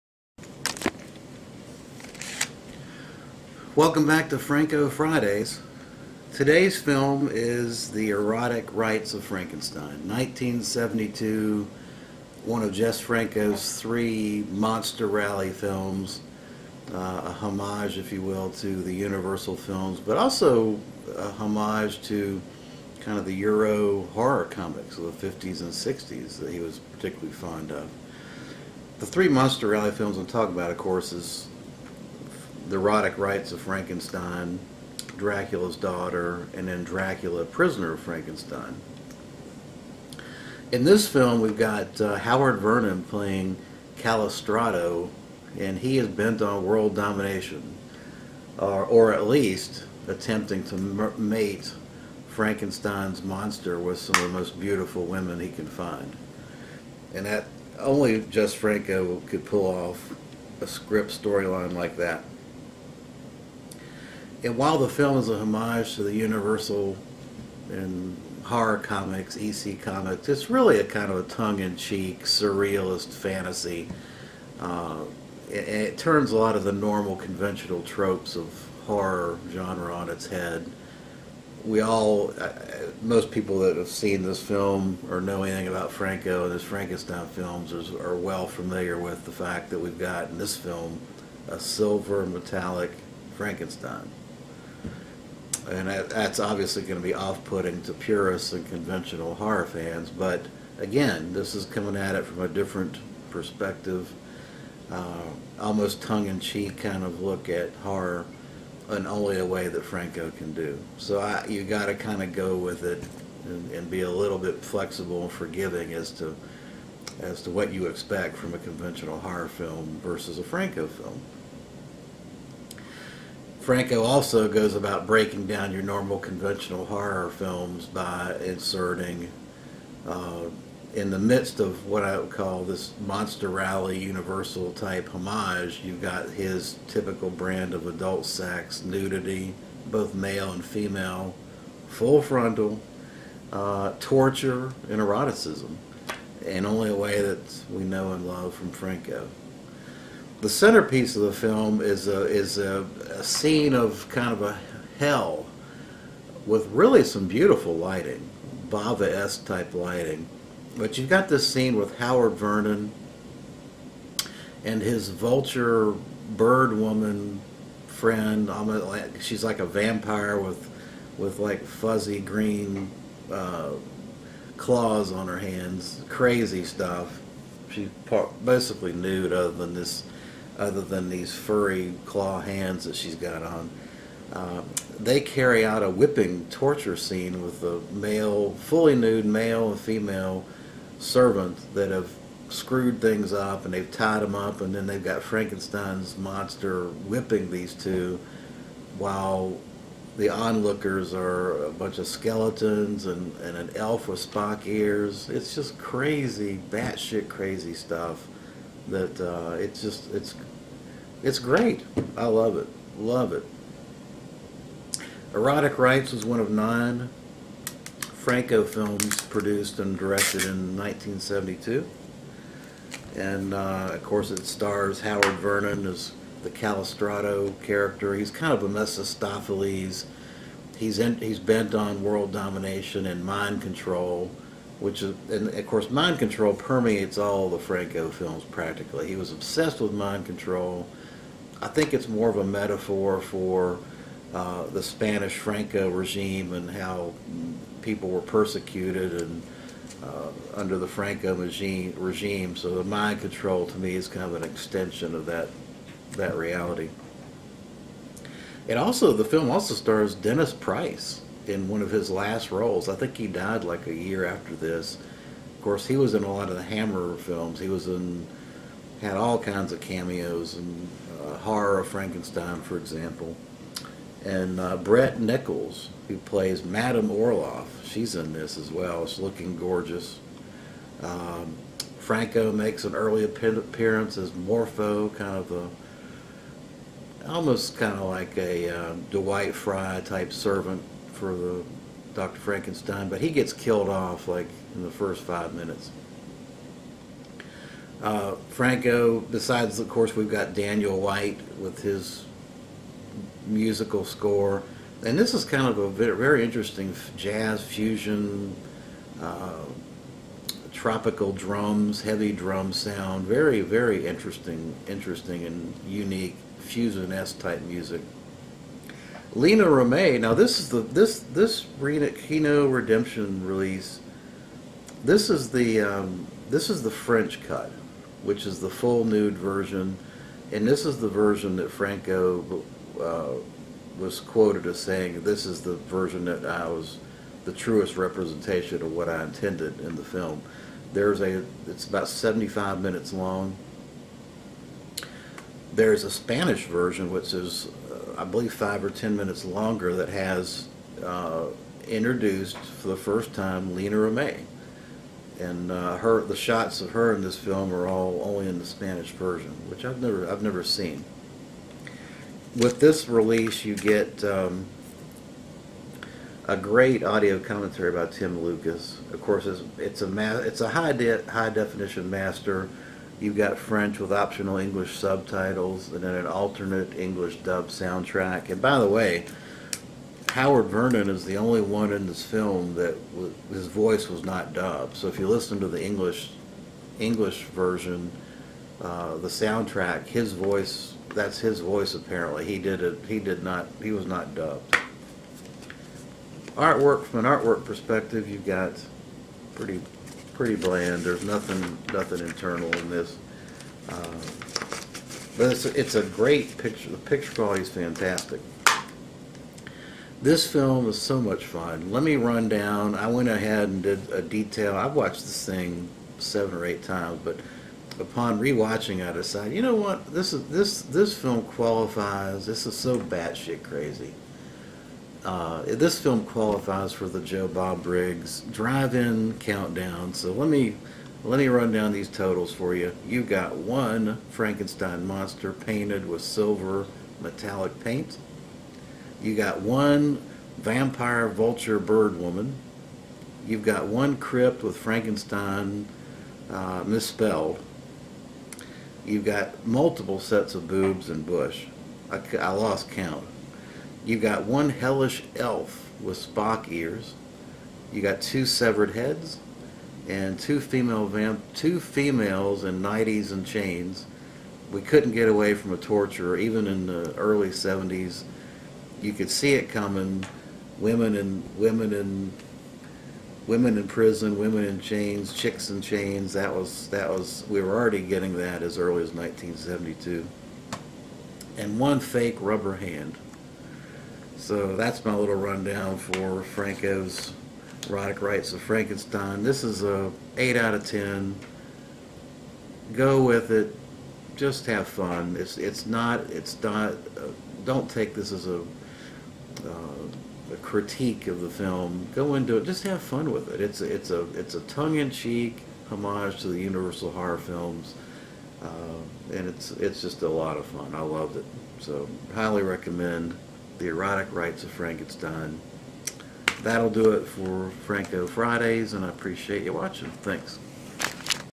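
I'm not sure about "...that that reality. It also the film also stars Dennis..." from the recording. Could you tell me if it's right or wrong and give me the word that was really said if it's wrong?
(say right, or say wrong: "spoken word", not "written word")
right.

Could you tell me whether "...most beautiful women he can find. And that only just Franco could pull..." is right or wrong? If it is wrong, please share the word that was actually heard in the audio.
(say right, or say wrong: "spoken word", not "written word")
right.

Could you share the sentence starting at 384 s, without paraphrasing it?
So if you listen to the English English version, uh, the soundtrack, his voice that's his voice apparently.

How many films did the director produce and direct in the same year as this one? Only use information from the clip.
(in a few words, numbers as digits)
9.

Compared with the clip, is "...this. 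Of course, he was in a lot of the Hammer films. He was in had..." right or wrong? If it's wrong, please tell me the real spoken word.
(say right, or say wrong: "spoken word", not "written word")
right.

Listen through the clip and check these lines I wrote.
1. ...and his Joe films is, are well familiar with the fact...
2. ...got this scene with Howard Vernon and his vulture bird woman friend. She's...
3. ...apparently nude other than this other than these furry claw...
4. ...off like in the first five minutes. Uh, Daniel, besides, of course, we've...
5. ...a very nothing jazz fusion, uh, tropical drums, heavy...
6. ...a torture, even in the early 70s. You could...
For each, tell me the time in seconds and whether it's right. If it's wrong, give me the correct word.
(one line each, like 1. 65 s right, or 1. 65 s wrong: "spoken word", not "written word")
1. 86 s wrong: "Frankenstein", not "Joe"
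2. 161 s right
3. 178 s wrong: "basically", not "apparently"
4. 293 s wrong: "Franco", not "Daniel"
5. 305 s wrong: "interesting", not "nothing"
6. 465 s right.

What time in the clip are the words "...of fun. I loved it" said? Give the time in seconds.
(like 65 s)
510 s.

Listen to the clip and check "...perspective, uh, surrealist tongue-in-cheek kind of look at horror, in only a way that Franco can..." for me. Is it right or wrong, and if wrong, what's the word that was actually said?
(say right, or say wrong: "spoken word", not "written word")
wrong: "almost", not "surrealist".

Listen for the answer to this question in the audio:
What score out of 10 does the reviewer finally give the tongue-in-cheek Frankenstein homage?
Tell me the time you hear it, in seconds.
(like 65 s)
490 s.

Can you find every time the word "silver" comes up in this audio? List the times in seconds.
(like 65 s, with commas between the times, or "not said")
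91 s, 436 s.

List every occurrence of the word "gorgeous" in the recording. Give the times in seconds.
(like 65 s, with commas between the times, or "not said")
279 s.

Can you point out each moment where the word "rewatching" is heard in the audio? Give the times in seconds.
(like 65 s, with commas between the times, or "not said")
418 s.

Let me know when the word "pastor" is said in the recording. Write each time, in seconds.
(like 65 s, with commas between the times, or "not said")
not said.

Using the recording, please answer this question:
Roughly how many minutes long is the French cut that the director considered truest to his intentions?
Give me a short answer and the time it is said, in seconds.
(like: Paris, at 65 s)
75, at 342 s.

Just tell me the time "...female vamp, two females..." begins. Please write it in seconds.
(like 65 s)
460 s.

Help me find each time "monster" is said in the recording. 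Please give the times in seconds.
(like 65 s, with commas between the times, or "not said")
14 s, 29 s, 53 s, 133 s, 196 s, 435 s.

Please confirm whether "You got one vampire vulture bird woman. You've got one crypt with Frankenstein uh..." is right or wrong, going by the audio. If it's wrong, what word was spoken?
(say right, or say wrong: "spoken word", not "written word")
right.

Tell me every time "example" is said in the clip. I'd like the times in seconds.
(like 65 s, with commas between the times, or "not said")
272 s.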